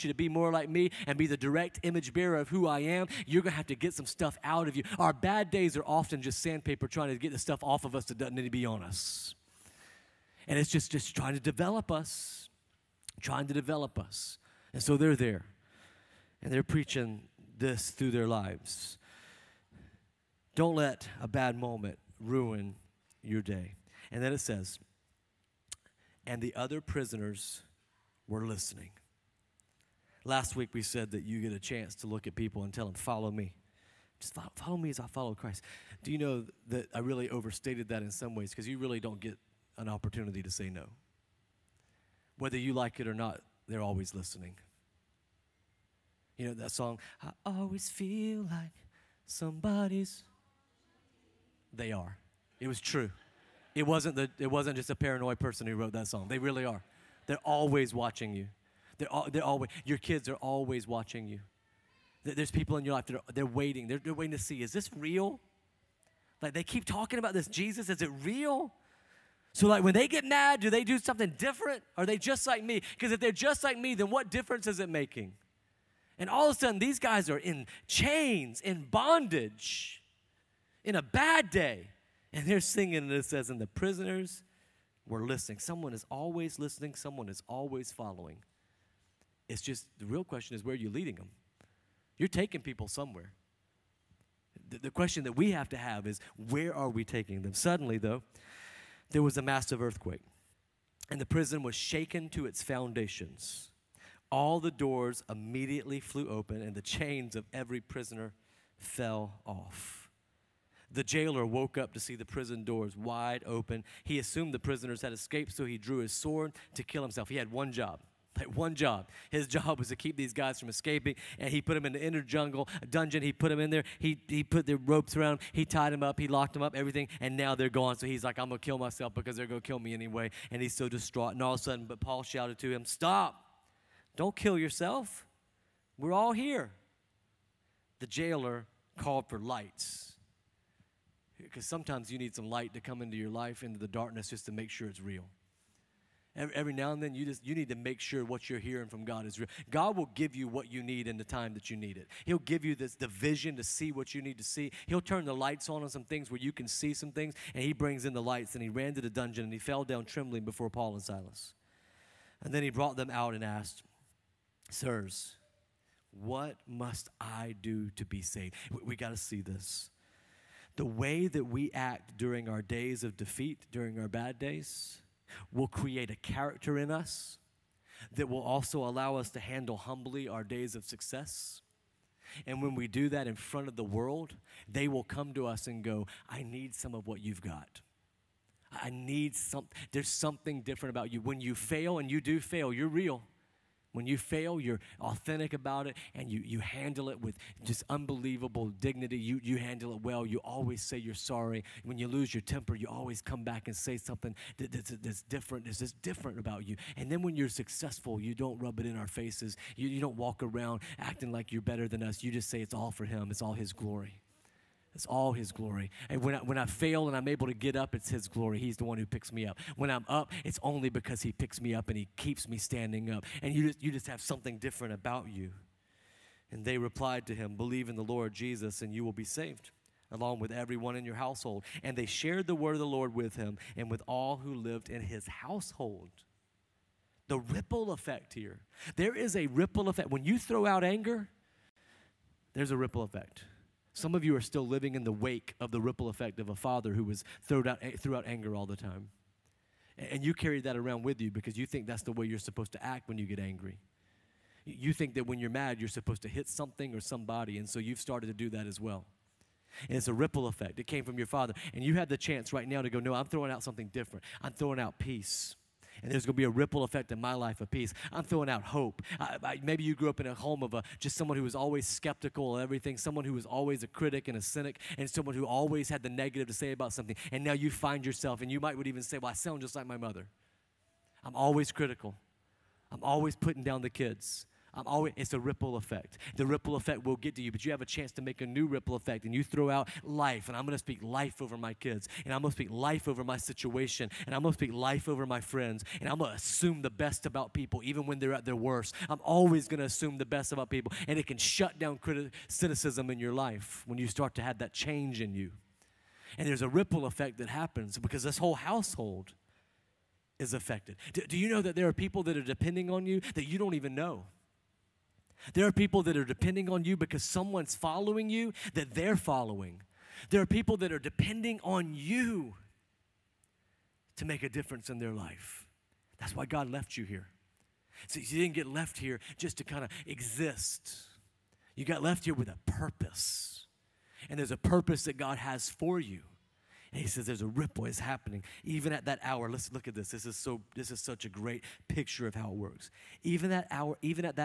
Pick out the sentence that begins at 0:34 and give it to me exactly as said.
Just follow, follow me as I follow Christ.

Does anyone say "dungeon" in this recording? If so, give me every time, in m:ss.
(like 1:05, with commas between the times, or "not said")
2:02, 2:39.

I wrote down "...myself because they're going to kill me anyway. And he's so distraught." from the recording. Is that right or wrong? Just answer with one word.
right.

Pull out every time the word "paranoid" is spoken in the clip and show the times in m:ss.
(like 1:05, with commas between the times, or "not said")
0:54.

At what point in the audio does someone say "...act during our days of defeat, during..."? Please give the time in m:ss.
2:51.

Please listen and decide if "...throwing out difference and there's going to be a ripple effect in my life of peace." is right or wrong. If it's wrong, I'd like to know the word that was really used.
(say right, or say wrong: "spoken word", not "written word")
wrong: "peace", not "difference".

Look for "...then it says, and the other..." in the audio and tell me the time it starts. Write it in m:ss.
0:24.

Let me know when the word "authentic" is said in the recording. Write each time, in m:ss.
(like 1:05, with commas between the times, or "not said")
3:14.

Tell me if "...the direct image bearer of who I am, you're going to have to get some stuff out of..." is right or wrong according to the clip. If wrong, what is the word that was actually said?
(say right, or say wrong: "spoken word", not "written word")
right.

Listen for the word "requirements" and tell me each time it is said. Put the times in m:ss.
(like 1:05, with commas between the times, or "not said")
not said.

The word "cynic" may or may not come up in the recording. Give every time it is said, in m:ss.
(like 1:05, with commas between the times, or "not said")
4:34.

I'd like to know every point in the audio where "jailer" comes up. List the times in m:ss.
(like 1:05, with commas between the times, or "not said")
1:51, 2:18.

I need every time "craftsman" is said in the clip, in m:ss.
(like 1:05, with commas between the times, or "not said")
not said.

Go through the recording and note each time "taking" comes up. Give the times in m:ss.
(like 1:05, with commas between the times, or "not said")
1:32, 1:37.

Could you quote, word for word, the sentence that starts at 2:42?
And then he brought them out and asked, Sirs, what must I do to be saved?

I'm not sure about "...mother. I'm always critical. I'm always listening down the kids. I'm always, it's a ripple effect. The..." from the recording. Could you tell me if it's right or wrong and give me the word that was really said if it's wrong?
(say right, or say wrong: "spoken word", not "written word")
wrong: "putting", not "listening".